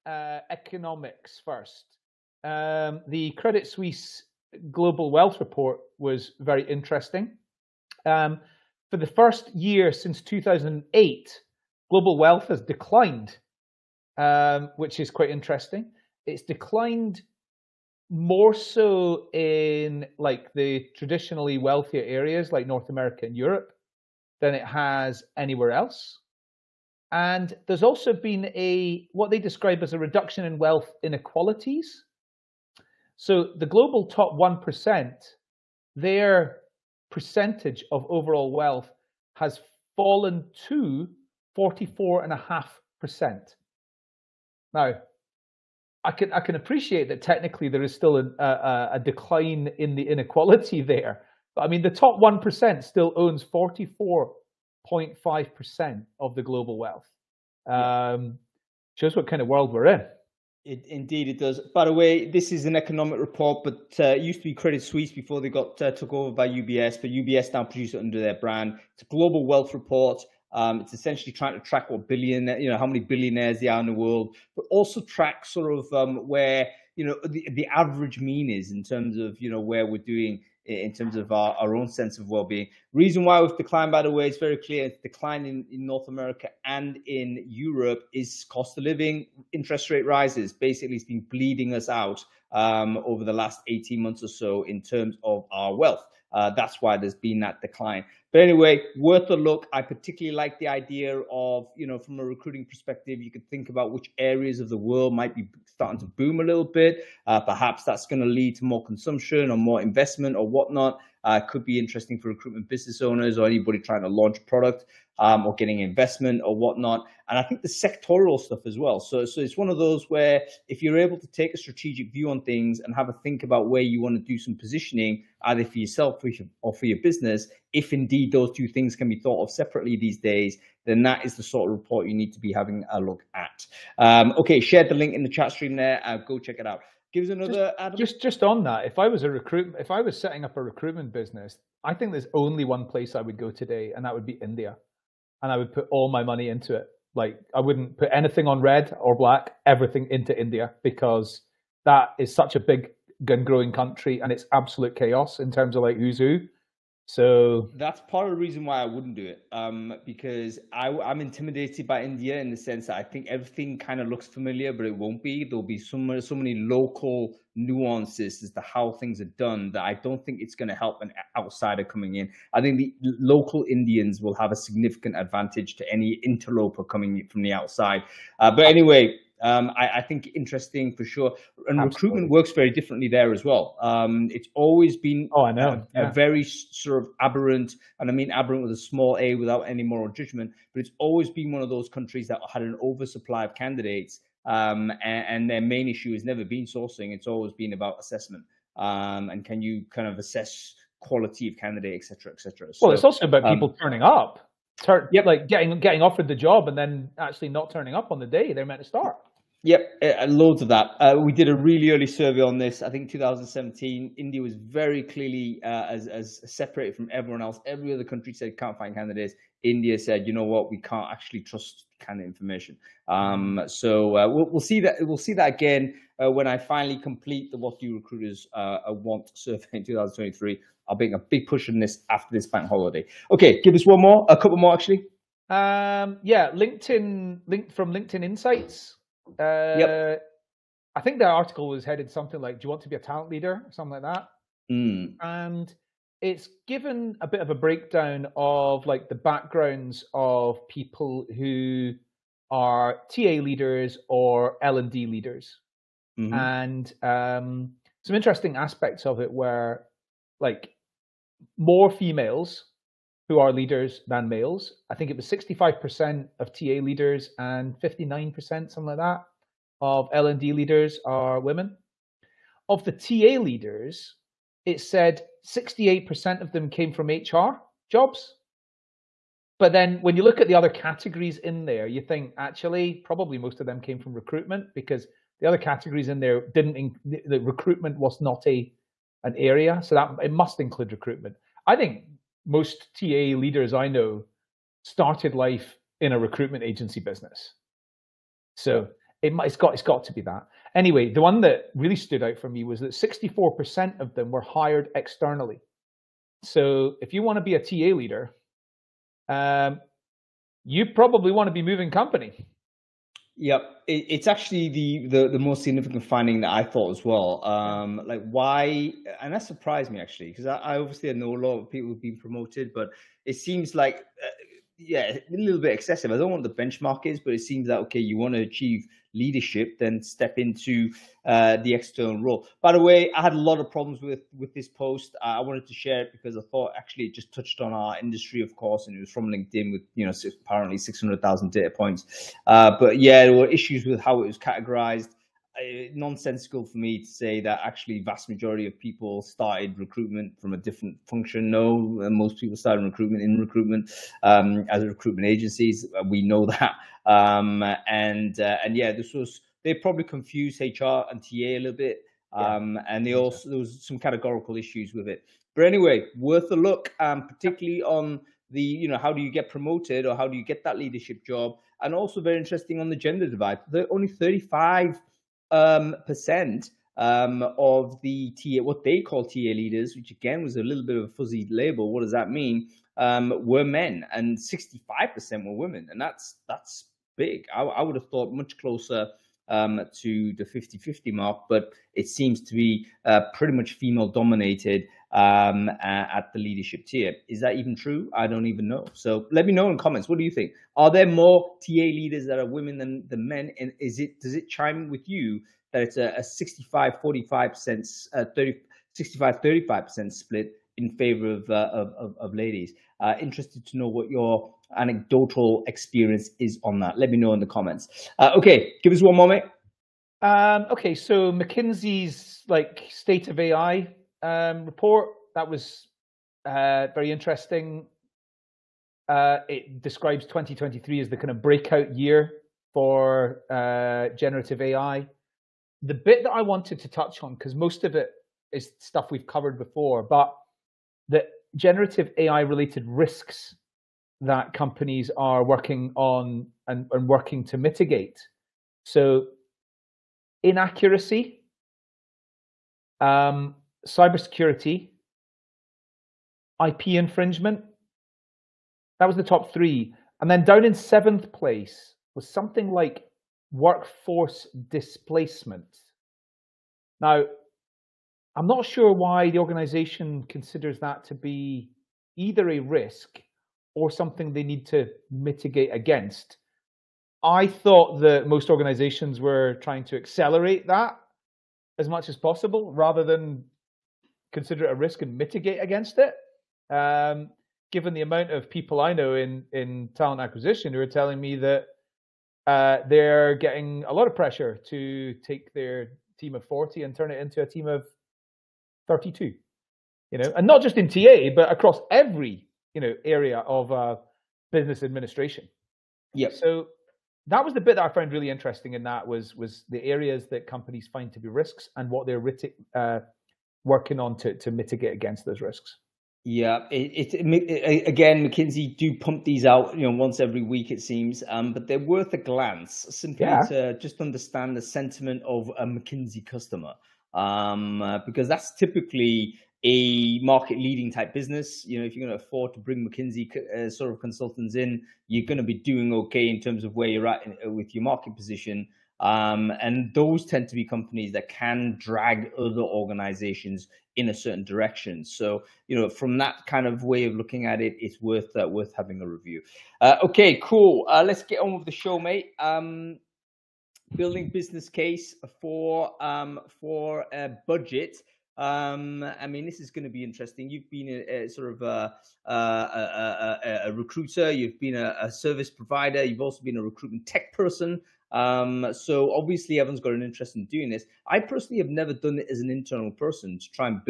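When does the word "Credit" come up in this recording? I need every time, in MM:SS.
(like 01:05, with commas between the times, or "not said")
00:03, 01:04.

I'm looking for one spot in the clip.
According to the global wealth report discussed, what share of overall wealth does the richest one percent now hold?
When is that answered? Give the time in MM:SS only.
00:41.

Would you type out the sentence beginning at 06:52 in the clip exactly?
Uh, interested to know what your anecdotal experience is on that.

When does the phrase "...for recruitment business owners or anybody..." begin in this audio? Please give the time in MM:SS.
01:52.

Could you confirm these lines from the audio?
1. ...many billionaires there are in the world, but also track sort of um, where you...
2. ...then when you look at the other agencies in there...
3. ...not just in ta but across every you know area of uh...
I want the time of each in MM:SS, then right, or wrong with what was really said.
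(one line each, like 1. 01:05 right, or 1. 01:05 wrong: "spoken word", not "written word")
1. 01:12 right
2. 04:39 wrong: "categories", not "agencies"
3. 08:20 right.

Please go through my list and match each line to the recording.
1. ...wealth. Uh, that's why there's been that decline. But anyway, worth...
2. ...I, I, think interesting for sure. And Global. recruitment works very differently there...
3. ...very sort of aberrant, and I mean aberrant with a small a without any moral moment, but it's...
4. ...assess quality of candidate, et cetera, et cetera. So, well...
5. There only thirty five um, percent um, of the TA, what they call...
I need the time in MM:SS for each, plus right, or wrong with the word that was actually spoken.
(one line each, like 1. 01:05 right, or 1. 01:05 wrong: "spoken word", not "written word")
1. 01:35 right
2. 02:59 wrong: "Absolutely", not "Global"
3. 03:06 wrong: "judgment", not "moment"
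4. 03:20 right
5. 06:13 right.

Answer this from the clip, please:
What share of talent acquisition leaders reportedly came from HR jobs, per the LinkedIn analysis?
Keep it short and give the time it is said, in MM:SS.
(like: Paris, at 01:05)
68%, at 04:35.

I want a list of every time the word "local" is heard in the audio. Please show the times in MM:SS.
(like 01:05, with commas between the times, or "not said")
02:46, 02:53.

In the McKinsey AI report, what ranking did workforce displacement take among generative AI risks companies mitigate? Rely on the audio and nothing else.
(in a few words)
seventh.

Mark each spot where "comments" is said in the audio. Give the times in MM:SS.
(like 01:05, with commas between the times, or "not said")
06:39, 06:57.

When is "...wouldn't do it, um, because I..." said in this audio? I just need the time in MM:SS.
02:38.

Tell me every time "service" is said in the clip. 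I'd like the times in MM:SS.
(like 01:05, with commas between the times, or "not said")
09:25.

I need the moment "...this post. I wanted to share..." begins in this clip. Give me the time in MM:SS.
05:34.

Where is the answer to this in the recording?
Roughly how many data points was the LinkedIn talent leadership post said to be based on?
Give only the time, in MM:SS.
05:40.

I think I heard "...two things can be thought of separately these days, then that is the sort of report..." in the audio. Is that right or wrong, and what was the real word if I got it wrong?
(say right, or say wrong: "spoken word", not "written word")
right.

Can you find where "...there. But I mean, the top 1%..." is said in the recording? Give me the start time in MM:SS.
00:50.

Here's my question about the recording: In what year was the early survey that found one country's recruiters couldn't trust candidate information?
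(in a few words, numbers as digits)
2017.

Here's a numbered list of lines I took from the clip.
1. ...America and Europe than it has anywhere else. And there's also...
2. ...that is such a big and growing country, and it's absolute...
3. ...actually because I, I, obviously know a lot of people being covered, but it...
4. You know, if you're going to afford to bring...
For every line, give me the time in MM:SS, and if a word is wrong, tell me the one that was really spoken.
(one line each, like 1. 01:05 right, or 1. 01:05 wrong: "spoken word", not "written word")
1. 00:22 right
2. 02:31 right
3. 05:19 wrong: "promoted", not "covered"
4. 08:51 right.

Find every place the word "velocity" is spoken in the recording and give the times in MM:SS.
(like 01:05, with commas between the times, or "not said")
not said.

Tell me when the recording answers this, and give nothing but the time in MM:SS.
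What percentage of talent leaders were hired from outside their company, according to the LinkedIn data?
05:02.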